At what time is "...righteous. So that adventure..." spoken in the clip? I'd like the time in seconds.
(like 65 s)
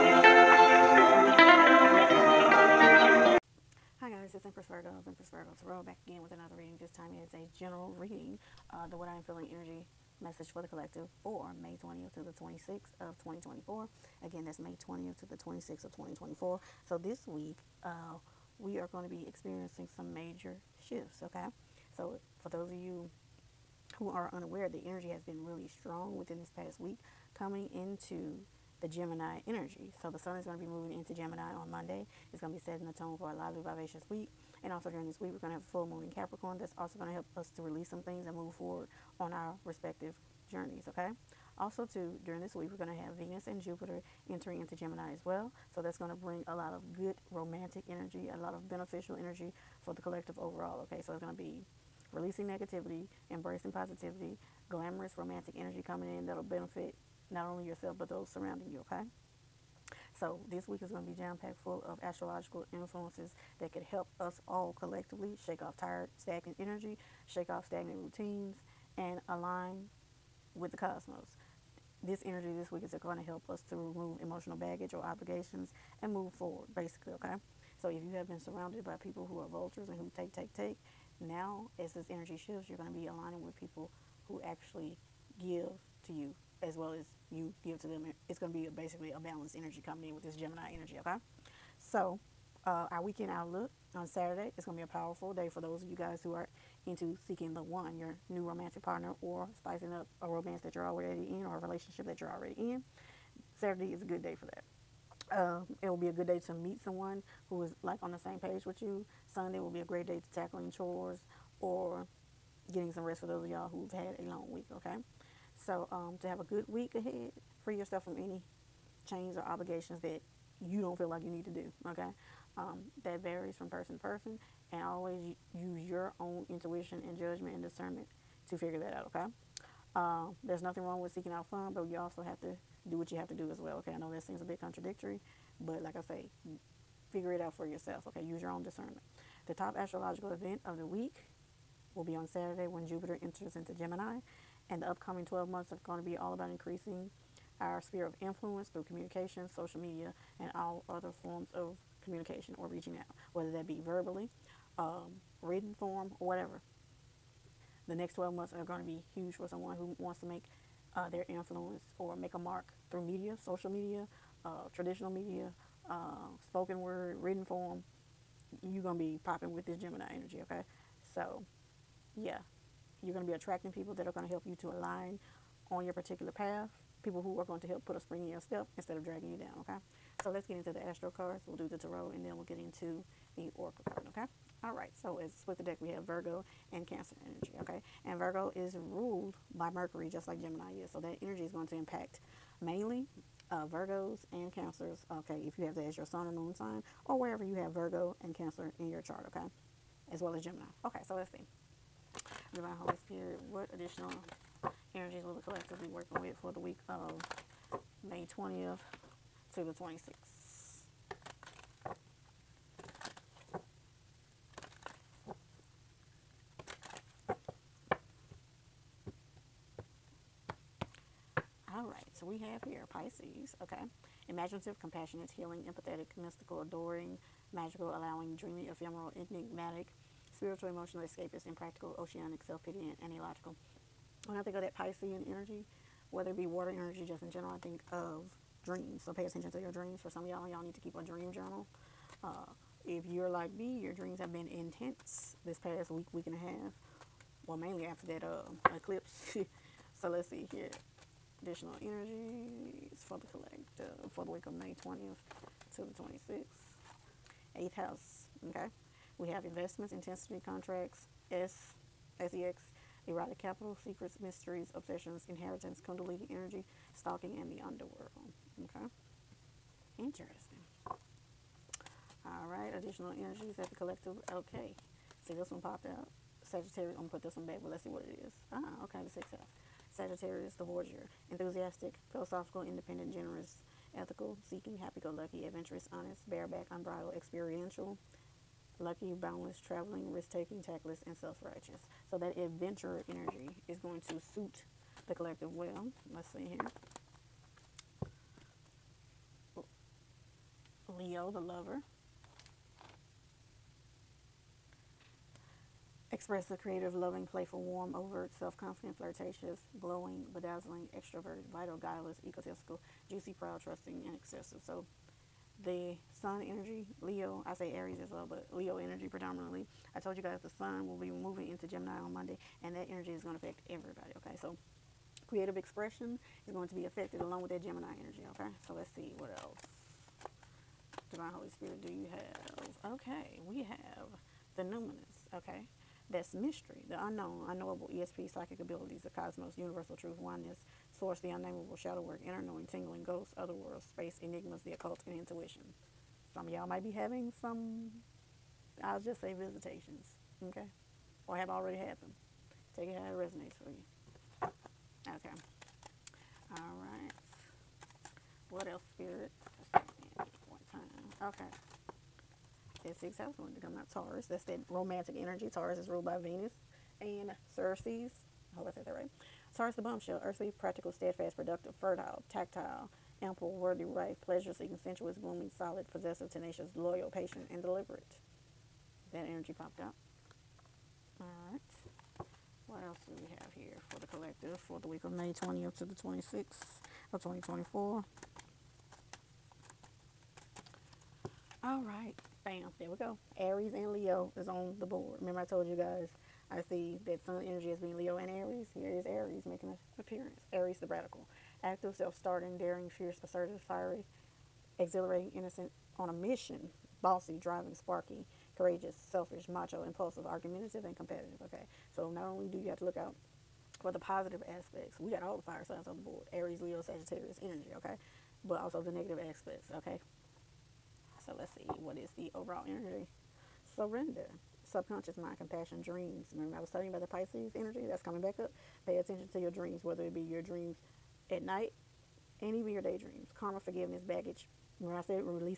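291 s.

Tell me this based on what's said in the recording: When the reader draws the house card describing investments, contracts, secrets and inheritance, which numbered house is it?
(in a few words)
Eighth house.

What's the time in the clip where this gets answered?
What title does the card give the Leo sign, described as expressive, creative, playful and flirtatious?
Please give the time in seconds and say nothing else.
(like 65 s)
300 s.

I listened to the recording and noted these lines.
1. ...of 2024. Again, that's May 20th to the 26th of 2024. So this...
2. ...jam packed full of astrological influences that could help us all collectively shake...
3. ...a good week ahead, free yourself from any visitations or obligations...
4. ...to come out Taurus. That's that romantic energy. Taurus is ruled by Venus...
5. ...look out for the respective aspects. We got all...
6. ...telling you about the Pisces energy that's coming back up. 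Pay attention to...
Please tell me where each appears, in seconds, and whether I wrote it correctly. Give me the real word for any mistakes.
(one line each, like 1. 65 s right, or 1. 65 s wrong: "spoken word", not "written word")
1. 12 s right
2. 61 s right
3. 116 s wrong: "chains", not "visitations"
4. 363 s right
5. 412 s wrong: "positive", not "respective"
6. 426 s right.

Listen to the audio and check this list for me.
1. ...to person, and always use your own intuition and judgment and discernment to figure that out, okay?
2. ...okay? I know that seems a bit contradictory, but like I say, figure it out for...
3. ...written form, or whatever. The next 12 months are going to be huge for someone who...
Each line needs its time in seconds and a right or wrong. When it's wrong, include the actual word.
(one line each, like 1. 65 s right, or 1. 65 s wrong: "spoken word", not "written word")
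1. 123 s right
2. 133 s right
3. 155 s right.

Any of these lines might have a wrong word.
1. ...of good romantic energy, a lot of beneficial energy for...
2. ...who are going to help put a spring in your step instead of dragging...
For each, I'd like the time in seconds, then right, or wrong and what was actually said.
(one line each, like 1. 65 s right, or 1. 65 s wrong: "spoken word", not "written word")
1. 46 s right
2. 177 s right.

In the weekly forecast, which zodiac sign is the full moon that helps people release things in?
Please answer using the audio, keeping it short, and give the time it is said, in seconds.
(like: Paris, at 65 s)
Capricorn, at 35 s.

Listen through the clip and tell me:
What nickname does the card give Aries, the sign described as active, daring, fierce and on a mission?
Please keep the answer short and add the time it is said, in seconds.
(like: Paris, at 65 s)
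The radical, at 400 s.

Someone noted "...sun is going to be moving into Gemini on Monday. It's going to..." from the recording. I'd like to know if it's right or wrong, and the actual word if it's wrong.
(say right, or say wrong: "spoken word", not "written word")
right.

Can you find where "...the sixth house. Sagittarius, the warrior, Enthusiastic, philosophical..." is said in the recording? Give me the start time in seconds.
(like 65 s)
279 s.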